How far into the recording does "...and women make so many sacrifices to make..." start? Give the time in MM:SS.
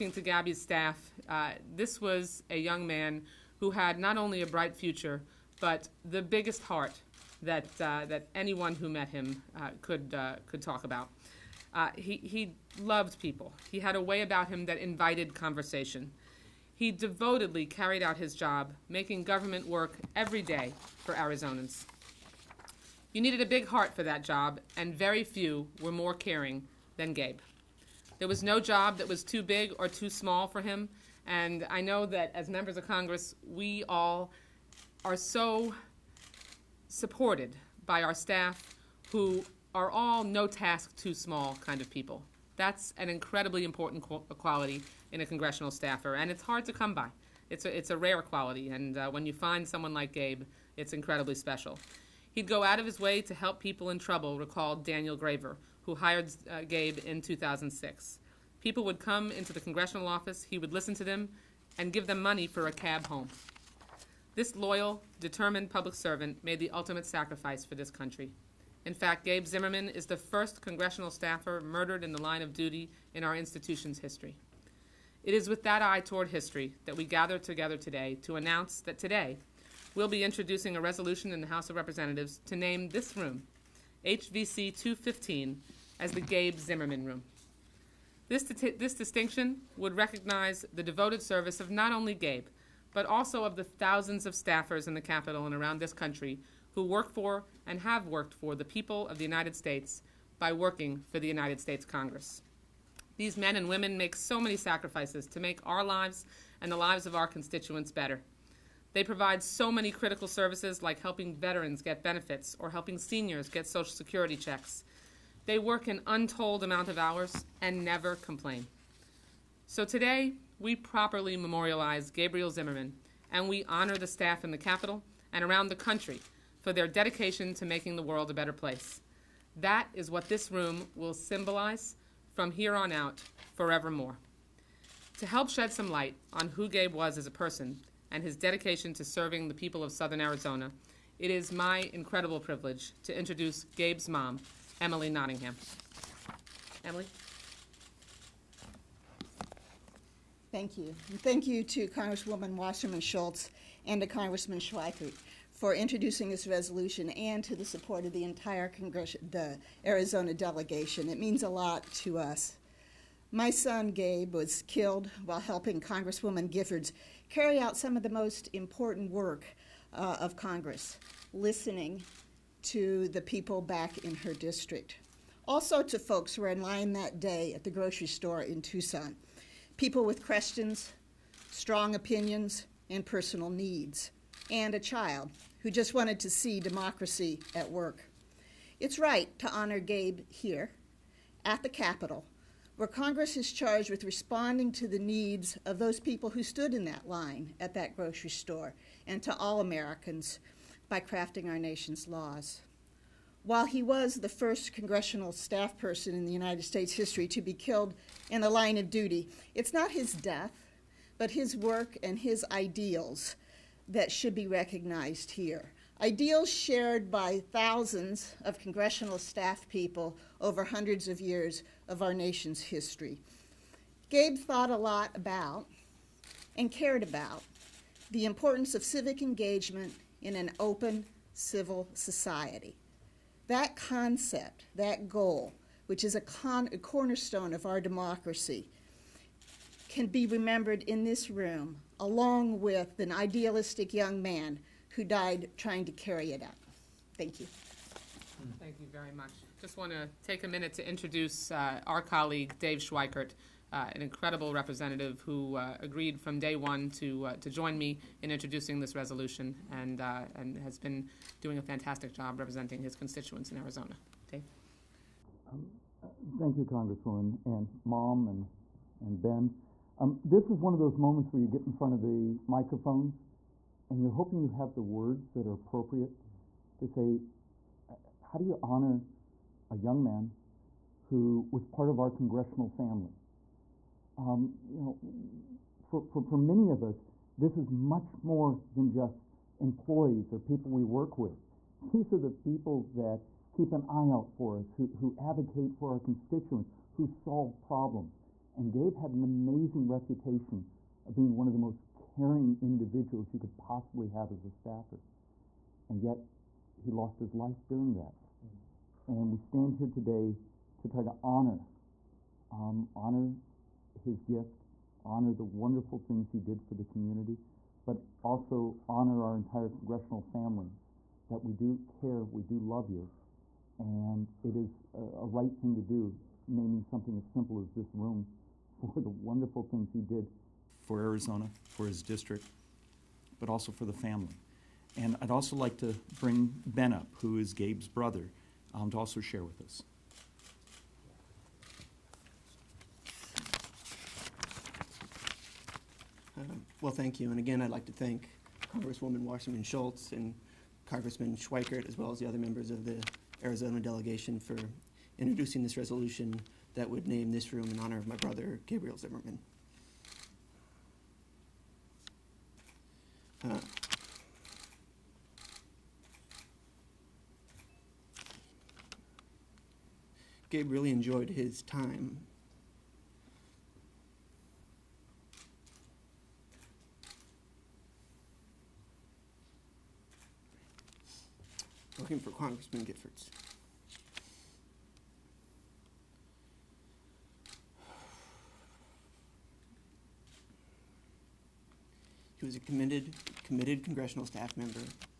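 01:43.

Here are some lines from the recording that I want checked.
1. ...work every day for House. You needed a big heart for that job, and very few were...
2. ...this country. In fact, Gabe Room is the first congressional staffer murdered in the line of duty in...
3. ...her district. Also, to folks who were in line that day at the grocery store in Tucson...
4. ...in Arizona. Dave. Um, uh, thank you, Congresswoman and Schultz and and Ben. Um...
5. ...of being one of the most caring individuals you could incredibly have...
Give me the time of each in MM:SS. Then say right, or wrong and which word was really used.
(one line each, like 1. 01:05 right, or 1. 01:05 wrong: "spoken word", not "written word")
1. 00:19 wrong: "Arizonans", not "House"
2. 01:07 wrong: "Zimmerman", not "Room"
3. 02:54 right
4. 04:23 wrong: "Mom", not "Schultz"
5. 05:01 wrong: "possibly", not "incredibly".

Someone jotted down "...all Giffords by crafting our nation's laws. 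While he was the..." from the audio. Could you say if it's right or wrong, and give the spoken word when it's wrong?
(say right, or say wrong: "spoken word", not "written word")
wrong: "Americans", not "Giffords".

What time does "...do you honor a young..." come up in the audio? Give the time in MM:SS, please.
04:38.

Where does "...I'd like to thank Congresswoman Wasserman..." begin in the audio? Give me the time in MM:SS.
05:47.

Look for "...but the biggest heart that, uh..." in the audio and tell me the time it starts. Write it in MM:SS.
00:05.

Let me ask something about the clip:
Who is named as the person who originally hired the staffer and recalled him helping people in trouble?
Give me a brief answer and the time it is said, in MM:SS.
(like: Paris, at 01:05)
Daniel Graver, at 00:54.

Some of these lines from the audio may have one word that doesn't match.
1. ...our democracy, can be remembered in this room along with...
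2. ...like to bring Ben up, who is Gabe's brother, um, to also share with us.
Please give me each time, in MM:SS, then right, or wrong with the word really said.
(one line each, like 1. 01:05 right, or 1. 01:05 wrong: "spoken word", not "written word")
1. 03:57 right
2. 05:35 right.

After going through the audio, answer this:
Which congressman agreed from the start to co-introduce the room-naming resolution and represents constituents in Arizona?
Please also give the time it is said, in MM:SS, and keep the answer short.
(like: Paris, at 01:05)
Dave Schweikert, at 04:12.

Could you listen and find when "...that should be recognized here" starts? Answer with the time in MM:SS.
03:33.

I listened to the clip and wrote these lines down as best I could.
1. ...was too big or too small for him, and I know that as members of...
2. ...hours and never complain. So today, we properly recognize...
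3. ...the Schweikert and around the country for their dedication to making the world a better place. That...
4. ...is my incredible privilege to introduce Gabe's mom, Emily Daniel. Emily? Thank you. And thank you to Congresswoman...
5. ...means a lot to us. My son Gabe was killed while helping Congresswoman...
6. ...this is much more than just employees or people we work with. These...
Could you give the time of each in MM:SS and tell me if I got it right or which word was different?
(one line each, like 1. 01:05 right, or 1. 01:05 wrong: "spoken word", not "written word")
1. 00:29 right
2. 01:56 wrong: "memorialize", not "recognize"
3. 02:04 wrong: "Capitol", not "Schweikert"
4. 02:21 wrong: "Nottingham", not "Daniel"
5. 02:41 right
6. 04:47 right.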